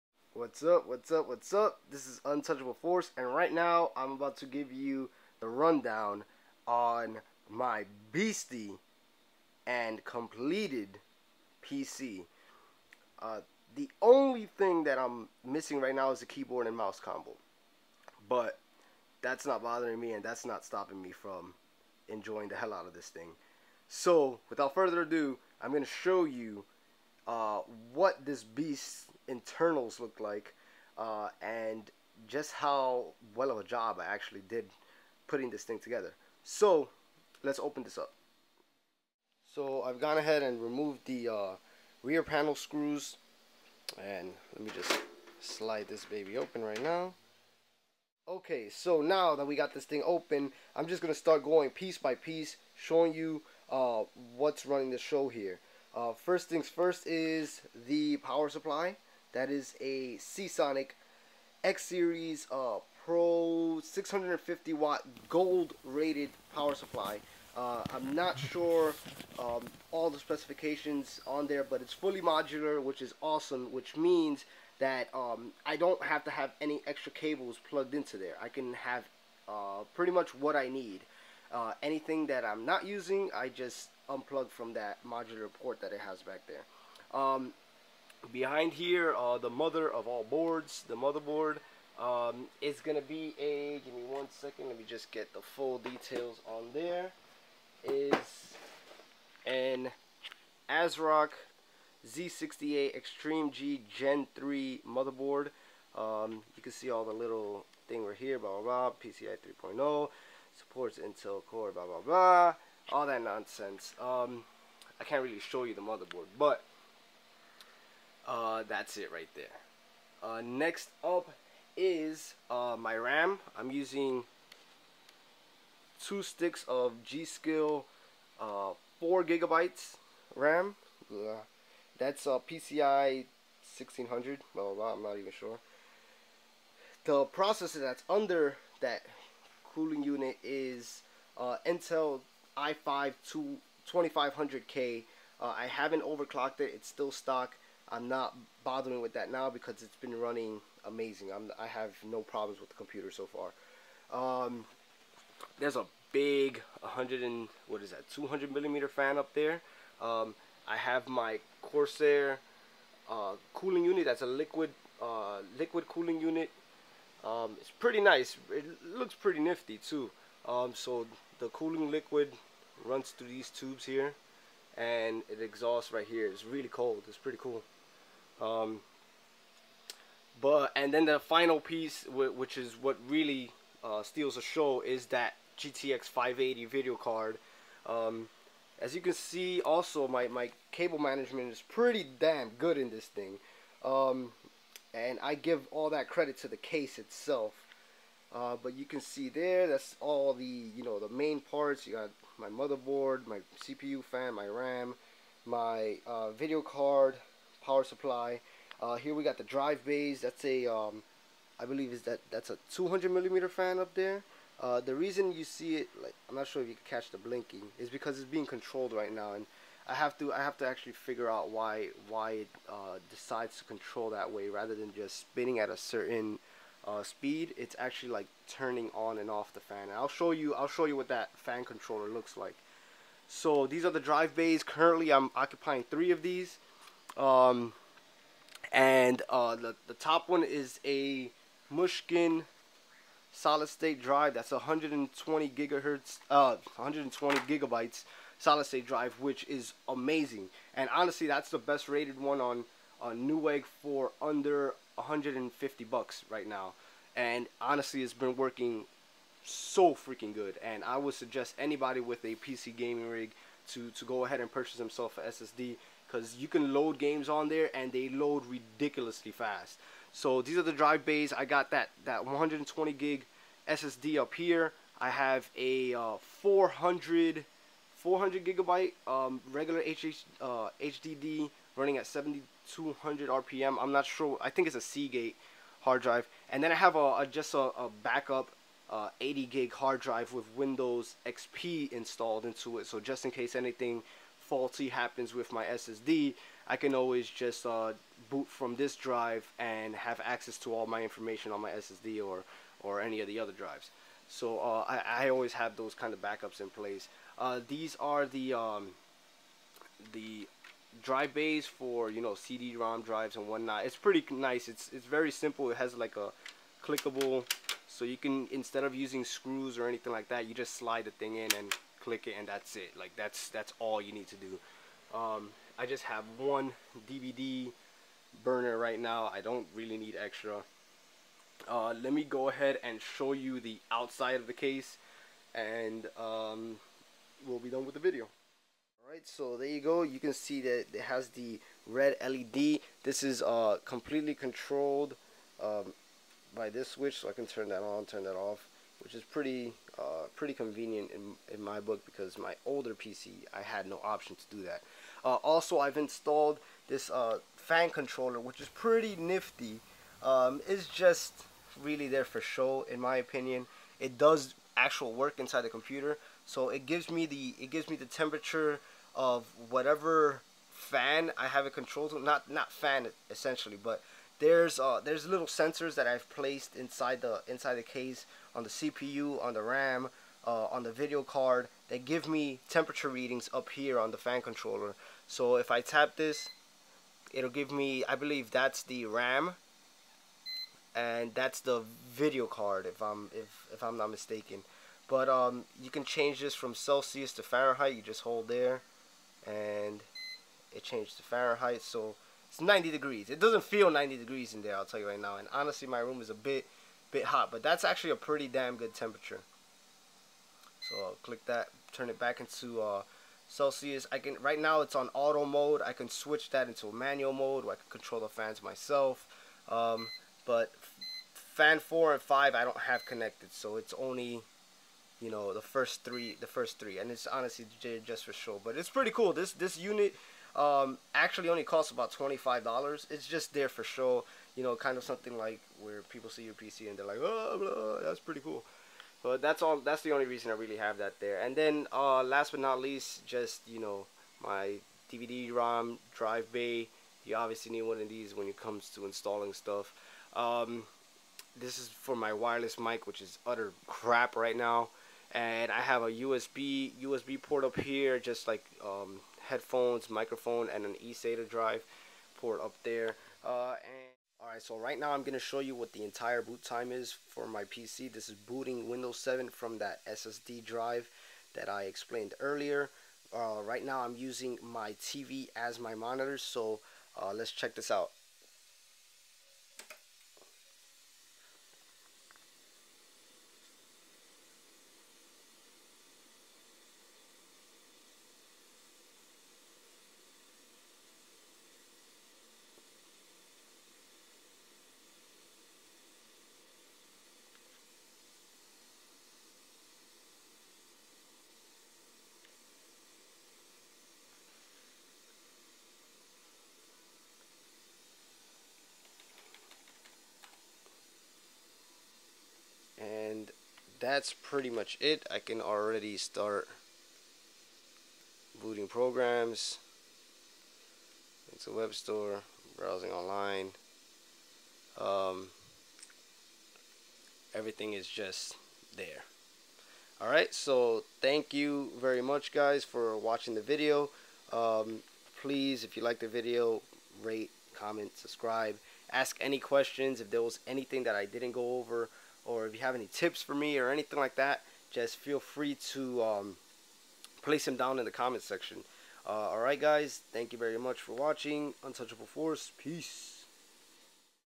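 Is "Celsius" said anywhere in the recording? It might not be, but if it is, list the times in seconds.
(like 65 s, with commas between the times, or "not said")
396 s, 413 s.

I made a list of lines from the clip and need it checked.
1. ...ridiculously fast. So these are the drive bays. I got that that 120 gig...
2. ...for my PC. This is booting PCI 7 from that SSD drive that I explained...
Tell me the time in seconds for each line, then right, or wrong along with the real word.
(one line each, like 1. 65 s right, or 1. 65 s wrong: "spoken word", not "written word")
1. 268 s right
2. 467 s wrong: "Windows", not "PCI".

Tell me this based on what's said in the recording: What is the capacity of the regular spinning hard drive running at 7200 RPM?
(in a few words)
400 gigabytes.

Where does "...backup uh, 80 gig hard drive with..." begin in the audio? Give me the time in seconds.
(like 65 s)
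288 s.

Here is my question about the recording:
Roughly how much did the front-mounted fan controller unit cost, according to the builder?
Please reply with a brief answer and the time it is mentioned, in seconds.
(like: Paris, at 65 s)
$25, at 432 s.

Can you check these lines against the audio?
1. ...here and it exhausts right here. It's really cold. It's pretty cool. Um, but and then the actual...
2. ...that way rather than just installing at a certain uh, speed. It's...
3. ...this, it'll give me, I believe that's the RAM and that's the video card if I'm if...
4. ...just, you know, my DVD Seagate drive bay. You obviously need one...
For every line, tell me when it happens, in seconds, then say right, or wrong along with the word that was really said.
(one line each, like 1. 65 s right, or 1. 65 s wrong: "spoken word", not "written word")
1. 173 s wrong: "final", not "actual"
2. 224 s wrong: "spinning", not "installing"
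3. 386 s right
4. 443 s wrong: "ROM", not "Seagate".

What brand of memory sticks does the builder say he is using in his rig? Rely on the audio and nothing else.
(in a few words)
G-Skill.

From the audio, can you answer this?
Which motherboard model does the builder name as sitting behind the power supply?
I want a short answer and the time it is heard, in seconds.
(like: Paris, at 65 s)
ASRock Z68 Extreme G Gen 3, at 100 s.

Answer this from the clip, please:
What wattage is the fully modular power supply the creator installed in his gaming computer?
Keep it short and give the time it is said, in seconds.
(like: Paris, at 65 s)
650 watt, at 63 s.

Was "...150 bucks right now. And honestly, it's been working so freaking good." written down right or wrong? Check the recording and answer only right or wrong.
right.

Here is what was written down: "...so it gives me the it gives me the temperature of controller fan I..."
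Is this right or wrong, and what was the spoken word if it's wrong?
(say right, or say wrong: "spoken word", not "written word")
wrong: "whatever", not "controller".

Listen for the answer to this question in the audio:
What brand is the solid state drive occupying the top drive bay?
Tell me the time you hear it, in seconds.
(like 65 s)
241 s.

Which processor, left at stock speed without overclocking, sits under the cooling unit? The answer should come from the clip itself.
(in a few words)
Intel i5 2500K.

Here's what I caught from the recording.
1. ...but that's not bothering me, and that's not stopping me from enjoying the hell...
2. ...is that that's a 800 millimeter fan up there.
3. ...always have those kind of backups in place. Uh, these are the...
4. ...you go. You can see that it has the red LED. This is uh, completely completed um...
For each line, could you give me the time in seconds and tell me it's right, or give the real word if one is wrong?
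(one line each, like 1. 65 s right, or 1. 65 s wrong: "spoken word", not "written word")
1. 18 s right
2. 211 s wrong: "200", not "800"
3. 305 s right
4. 339 s wrong: "controlled", not "completed".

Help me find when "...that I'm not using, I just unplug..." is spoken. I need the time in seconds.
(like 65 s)
82 s.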